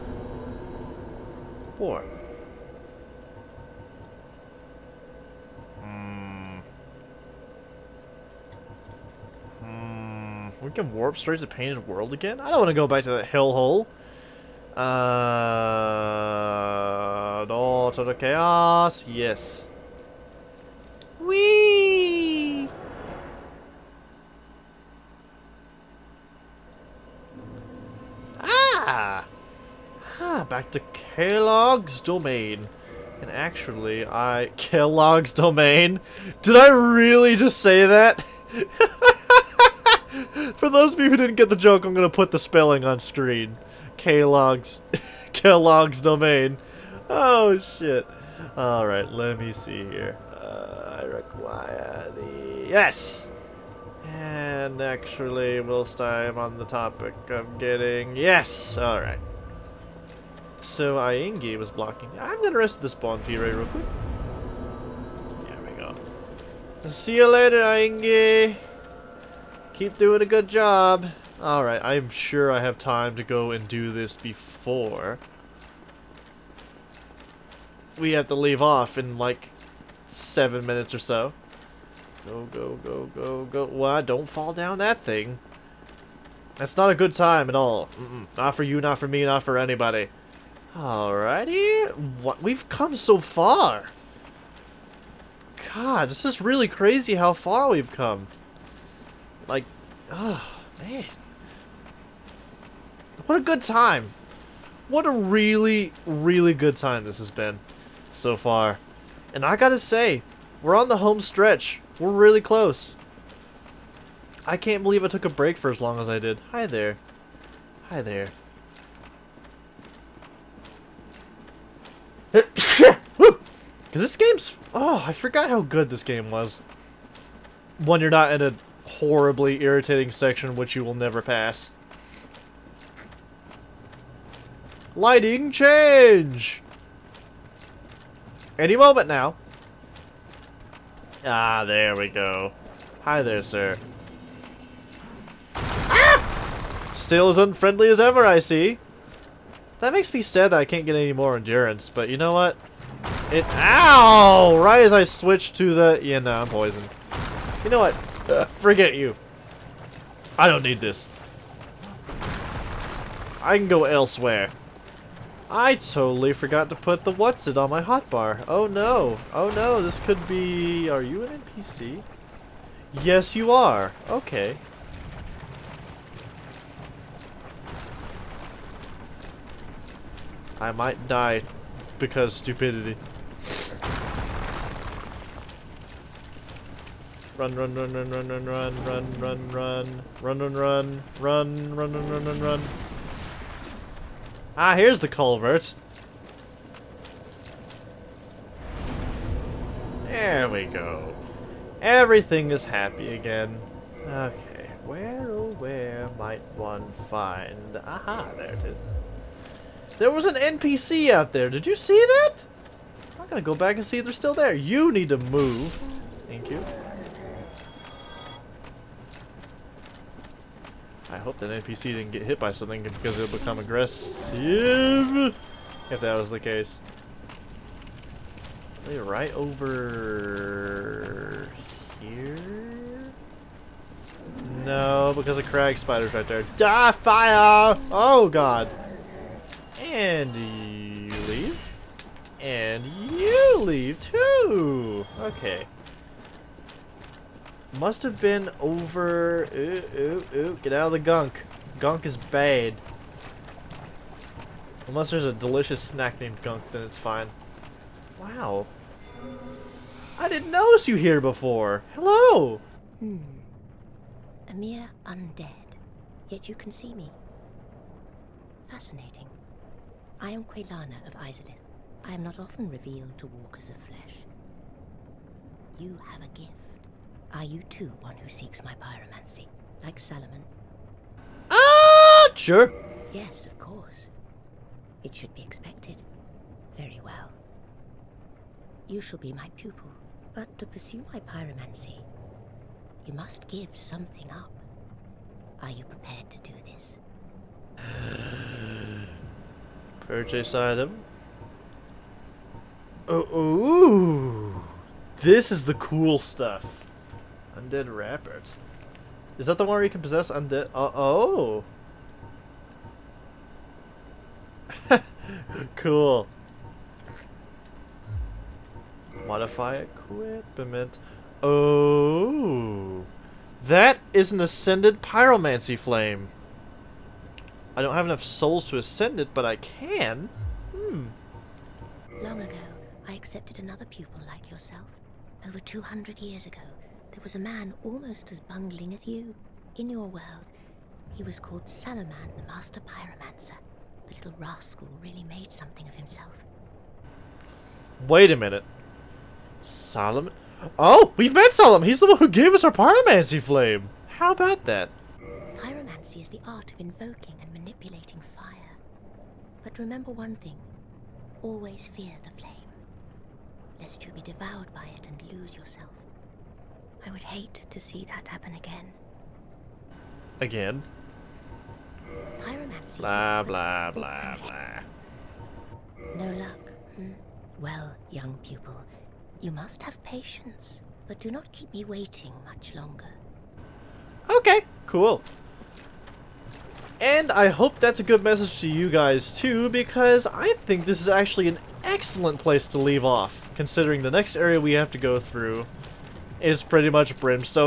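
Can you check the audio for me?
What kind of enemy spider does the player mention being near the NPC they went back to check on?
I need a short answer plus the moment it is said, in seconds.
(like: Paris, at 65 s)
Crag spider, at 235 s.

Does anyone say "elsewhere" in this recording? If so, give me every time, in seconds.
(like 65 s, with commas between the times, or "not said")
163 s.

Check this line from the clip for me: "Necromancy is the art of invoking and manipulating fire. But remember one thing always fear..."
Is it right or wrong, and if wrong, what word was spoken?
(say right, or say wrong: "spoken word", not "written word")
right.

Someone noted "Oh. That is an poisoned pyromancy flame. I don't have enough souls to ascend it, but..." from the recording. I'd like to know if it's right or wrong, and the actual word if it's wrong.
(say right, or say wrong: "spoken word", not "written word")
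wrong: "ascended", not "poisoned".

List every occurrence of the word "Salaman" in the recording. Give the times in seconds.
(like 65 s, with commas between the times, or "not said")
279 s, 341 s.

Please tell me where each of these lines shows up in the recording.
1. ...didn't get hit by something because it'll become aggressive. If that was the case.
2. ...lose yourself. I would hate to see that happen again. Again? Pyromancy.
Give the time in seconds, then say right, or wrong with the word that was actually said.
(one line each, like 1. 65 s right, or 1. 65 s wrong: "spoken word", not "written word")
1. 221 s right
2. 365 s right.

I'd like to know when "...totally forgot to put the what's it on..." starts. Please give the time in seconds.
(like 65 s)
165 s.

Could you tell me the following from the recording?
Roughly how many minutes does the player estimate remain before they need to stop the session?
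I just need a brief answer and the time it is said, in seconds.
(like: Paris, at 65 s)
7, at 80 s.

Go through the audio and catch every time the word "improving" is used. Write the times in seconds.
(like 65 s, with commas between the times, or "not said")
not said.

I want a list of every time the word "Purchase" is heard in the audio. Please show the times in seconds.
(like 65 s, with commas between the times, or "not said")
300 s.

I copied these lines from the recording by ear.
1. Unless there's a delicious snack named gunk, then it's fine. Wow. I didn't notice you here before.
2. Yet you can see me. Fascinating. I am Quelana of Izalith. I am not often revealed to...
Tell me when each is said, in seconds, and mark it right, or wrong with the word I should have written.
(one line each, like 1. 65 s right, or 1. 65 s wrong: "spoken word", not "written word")
1. 254 s right
2. 266 s right.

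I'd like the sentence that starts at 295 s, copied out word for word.
Are you prepared to do this?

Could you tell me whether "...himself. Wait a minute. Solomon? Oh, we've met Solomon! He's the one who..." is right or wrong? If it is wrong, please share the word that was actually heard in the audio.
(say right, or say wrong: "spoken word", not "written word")
right.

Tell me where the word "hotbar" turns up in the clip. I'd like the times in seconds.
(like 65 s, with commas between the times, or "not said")
167 s.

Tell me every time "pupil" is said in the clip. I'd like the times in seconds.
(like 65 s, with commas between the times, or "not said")
289 s, 333 s, 378 s.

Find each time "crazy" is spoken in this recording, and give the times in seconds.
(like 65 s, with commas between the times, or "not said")
96 s.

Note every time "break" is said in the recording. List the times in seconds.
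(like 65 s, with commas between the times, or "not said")
115 s.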